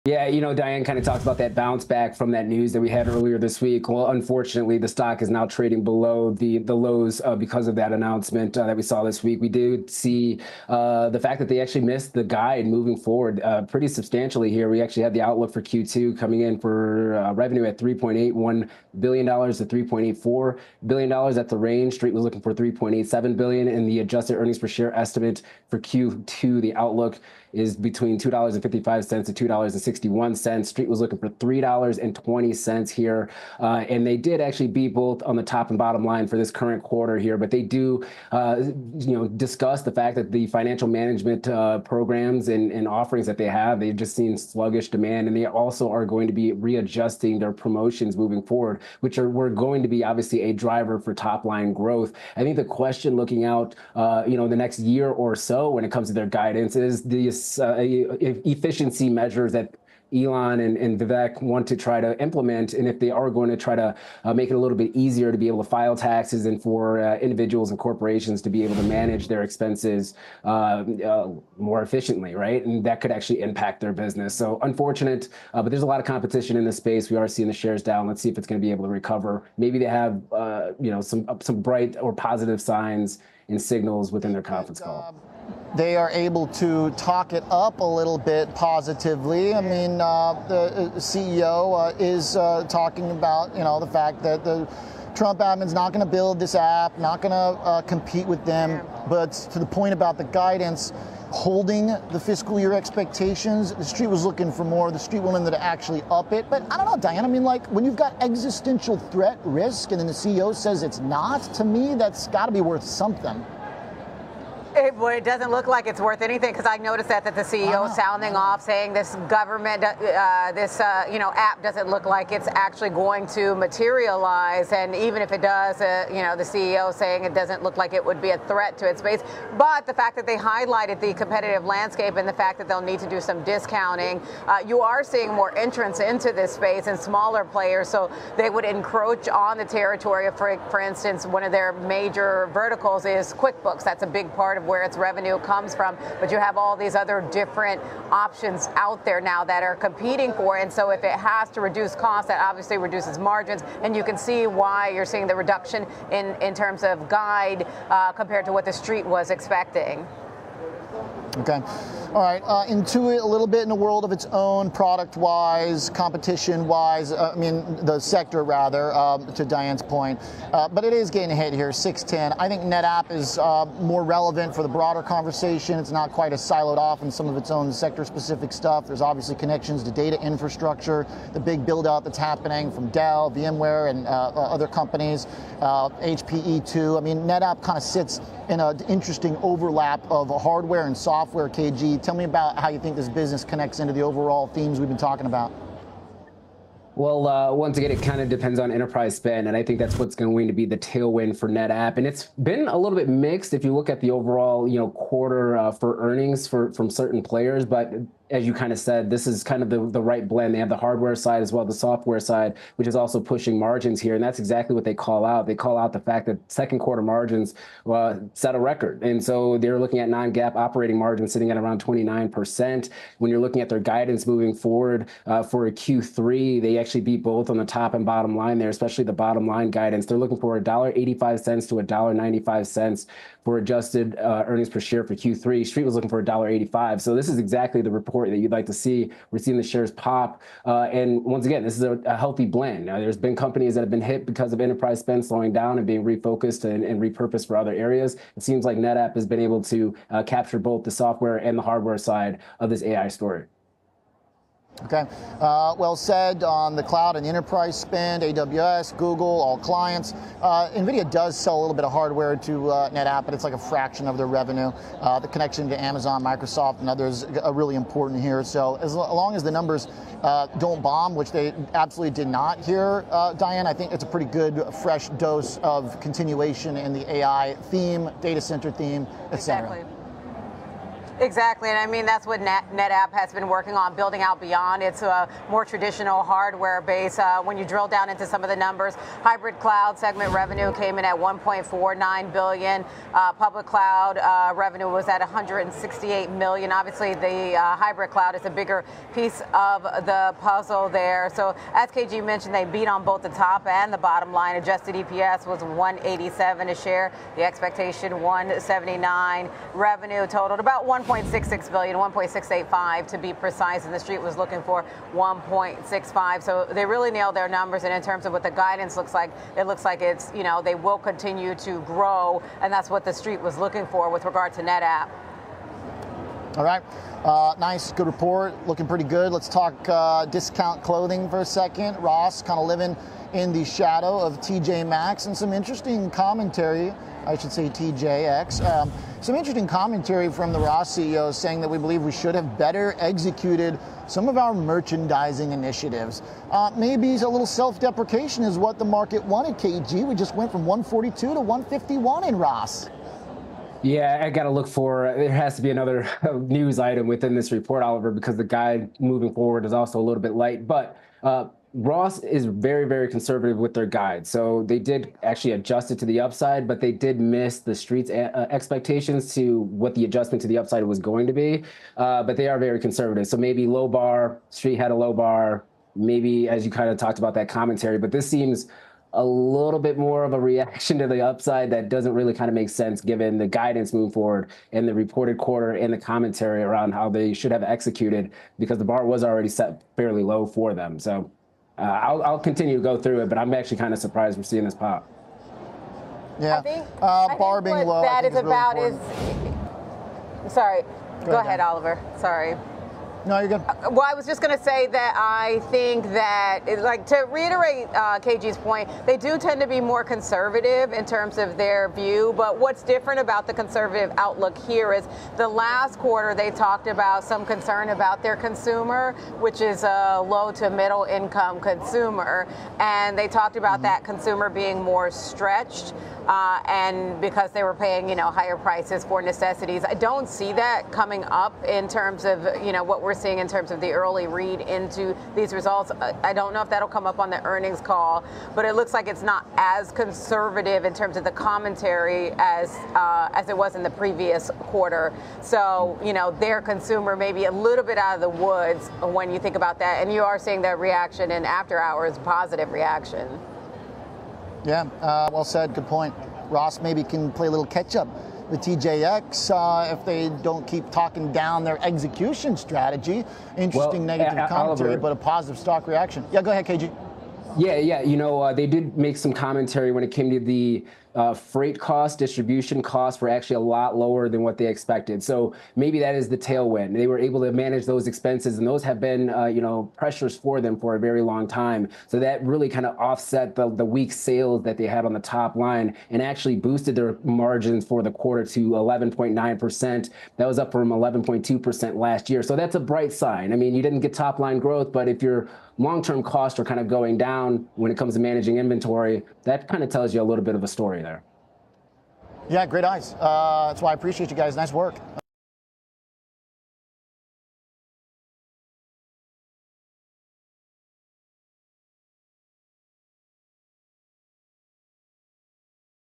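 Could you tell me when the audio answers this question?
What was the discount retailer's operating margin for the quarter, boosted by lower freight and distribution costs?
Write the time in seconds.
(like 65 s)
488 s.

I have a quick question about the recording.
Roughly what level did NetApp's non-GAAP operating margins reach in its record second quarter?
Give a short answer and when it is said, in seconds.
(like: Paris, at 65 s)
29%, at 221 s.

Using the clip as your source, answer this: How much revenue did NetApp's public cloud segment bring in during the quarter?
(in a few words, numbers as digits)
168 million.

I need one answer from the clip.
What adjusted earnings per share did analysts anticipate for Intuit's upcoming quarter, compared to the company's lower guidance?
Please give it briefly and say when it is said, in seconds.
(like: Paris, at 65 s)
$3.20, at 31 s.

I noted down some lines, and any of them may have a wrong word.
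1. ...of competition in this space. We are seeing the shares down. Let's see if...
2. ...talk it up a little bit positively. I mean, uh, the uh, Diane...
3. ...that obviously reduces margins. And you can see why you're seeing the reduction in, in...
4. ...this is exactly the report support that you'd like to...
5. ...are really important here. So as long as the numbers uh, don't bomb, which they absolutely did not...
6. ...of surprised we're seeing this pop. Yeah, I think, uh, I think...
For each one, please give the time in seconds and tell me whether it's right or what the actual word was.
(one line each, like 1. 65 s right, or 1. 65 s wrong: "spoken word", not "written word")
1. 76 s right
2. 86 s wrong: "CEO", not "Diane"
3. 152 s right
4. 237 s right
5. 267 s right
6. 393 s right.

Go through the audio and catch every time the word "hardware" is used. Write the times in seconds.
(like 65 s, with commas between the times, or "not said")
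190 s, 210 s, 251 s, 261 s, 286 s.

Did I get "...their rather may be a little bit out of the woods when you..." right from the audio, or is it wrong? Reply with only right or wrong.
wrong.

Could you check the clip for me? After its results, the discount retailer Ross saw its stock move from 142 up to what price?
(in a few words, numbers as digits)
151.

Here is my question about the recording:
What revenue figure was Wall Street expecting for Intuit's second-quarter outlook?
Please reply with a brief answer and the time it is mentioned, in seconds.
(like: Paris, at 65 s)
$3.87 billion, at 22 s.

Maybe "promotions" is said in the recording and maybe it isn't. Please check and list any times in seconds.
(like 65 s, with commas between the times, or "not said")
47 s.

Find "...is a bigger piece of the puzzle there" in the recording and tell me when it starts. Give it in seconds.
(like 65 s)
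298 s.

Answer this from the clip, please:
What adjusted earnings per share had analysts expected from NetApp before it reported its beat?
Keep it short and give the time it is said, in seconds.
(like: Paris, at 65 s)
$1.79, at 308 s.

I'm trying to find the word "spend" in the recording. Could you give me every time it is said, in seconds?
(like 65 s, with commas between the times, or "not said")
199 s, 244 s, 257 s.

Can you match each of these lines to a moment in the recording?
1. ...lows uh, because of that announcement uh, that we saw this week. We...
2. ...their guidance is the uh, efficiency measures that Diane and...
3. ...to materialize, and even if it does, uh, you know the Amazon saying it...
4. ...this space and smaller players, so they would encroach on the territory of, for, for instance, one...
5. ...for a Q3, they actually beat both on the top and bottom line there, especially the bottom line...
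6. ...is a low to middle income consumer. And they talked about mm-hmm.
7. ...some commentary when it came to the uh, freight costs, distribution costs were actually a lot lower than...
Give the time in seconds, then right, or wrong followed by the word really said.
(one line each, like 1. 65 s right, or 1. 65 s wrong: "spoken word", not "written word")
1. 6 s right
2. 56 s wrong: "Elon", not "Diane"
3. 123 s wrong: "CEO", not "Amazon"
4. 136 s right
5. 225 s right
6. 419 s right
7. 469 s right.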